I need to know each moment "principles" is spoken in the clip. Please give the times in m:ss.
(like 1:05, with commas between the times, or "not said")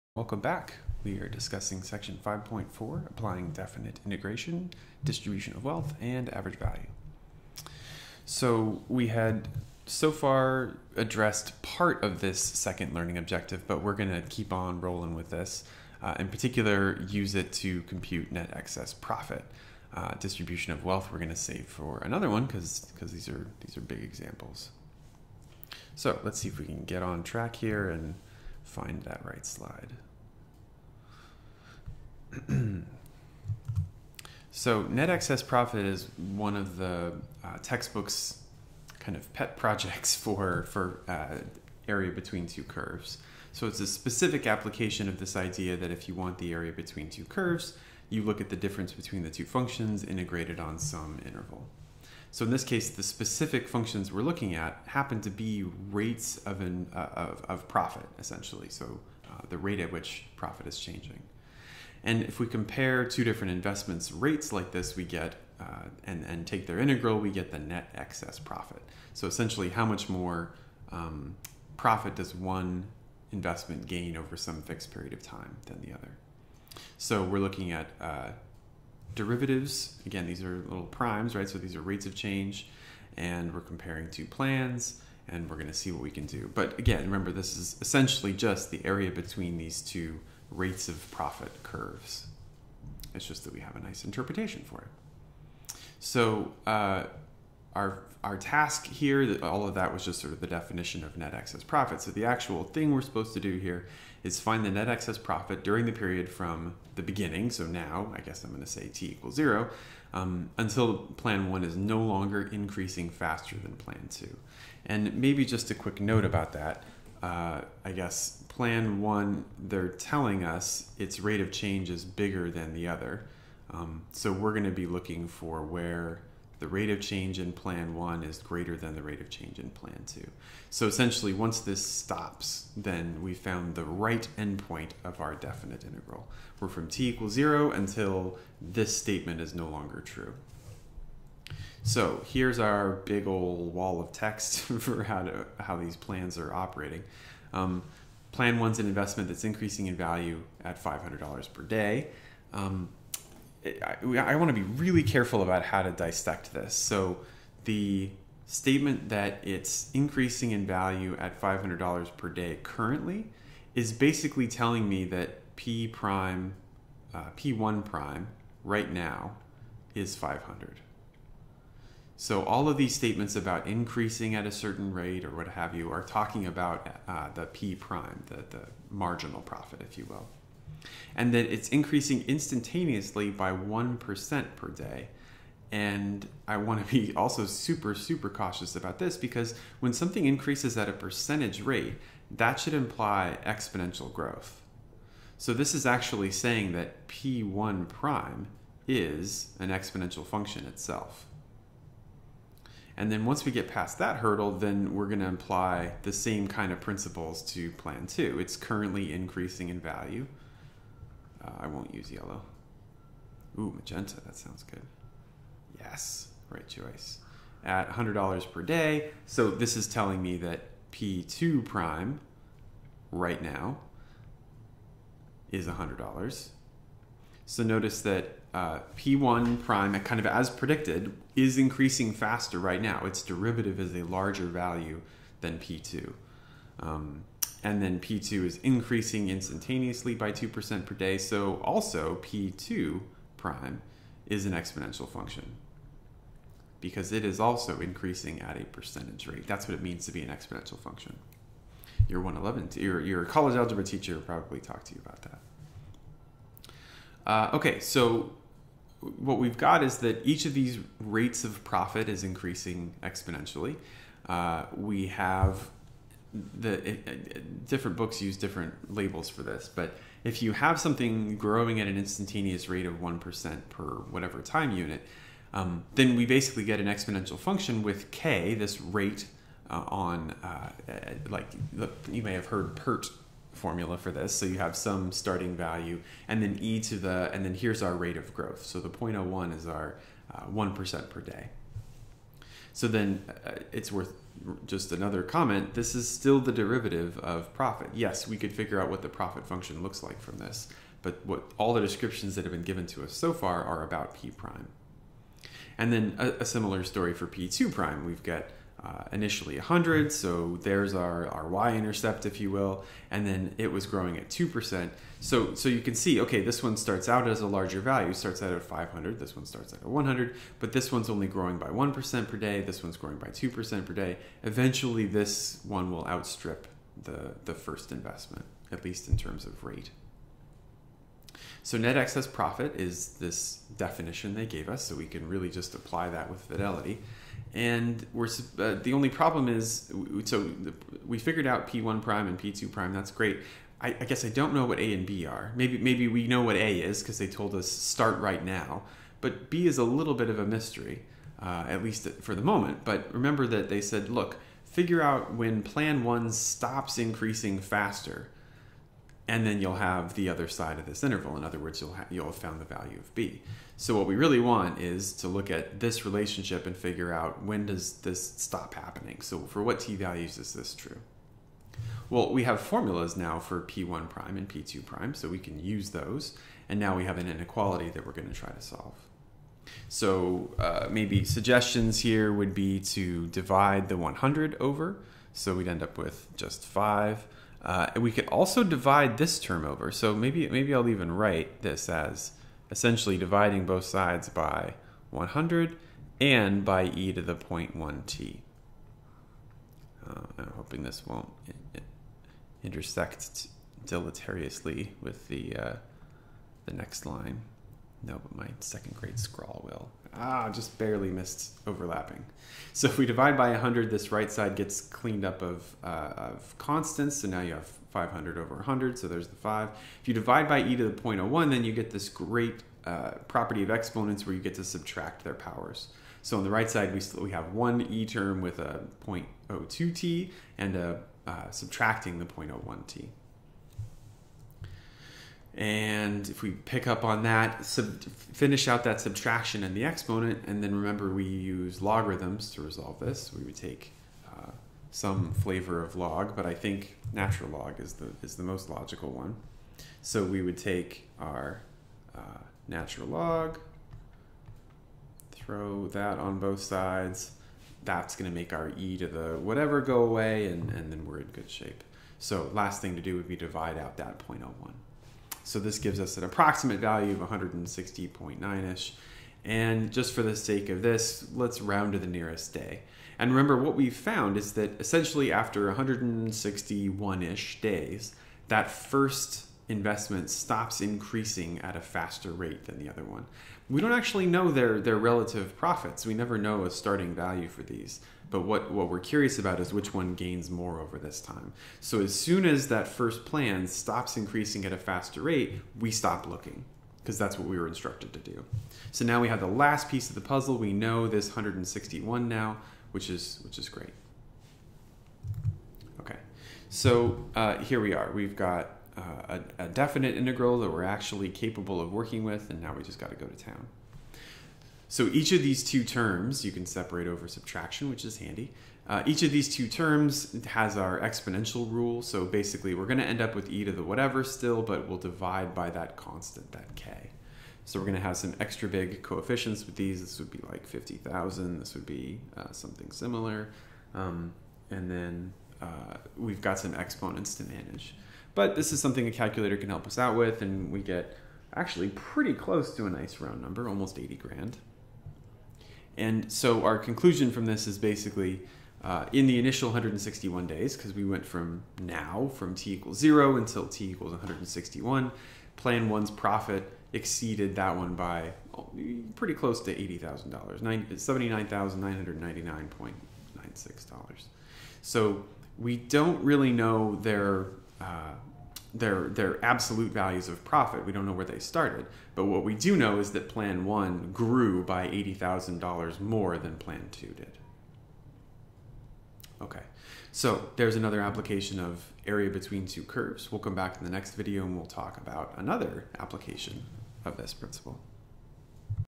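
3:26, 9:47.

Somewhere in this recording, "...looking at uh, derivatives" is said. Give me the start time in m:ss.
1:17.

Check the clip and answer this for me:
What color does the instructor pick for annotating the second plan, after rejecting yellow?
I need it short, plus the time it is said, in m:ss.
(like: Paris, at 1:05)
Magenta, at 3:33.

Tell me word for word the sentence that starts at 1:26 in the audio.
But again, remember, this is essentially just the area between these two rates of profit curves.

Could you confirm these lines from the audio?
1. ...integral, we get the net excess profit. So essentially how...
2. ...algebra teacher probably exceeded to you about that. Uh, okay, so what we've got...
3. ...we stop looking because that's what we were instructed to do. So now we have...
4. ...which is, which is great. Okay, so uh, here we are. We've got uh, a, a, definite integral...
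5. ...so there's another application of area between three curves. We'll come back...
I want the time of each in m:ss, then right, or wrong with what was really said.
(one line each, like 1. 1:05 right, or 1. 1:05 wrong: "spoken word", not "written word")
1. 1:06 right
2. 4:13 wrong: "talked", not "exceeded"
3. 8:15 right
4. 8:22 right
5. 9:40 wrong: "two", not "three".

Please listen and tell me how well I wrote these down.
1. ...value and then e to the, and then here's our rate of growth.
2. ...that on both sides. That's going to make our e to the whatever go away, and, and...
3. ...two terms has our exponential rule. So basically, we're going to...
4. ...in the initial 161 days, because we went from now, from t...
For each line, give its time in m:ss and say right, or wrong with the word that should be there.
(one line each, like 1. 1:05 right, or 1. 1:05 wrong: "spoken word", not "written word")
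1. 4:45 right
2. 7:35 right
3. 8:39 right
4. 9:09 right.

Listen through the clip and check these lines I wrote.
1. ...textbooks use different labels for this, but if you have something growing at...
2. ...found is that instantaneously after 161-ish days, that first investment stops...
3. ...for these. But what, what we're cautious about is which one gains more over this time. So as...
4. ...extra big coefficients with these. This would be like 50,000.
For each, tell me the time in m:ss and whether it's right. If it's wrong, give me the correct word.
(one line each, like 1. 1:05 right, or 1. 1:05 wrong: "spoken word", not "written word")
1. 4:27 wrong: "books", not "textbooks"
2. 7:53 wrong: "essentially", not "instantaneously"
3. 8:07 wrong: "curious", not "cautious"
4. 8:48 right.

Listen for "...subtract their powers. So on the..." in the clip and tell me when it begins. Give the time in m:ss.
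7:04.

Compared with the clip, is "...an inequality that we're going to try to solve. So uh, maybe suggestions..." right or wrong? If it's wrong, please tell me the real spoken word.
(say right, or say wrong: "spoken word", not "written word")
right.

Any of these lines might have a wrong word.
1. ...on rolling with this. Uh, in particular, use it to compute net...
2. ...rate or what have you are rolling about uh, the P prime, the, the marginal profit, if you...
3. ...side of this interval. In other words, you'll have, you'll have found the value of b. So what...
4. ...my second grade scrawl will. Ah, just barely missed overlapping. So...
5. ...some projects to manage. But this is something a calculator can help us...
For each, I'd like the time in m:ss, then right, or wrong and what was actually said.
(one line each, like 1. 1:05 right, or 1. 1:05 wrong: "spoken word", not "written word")
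1. 0:14 right
2. 2:54 wrong: "talking", not "rolling"
3. 6:00 right
4. 6:48 right
5. 8:56 wrong: "exponents", not "projects".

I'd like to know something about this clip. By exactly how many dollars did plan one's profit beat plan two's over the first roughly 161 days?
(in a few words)
$79,999.96.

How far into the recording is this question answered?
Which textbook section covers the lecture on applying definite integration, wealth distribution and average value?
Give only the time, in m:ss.
0:01.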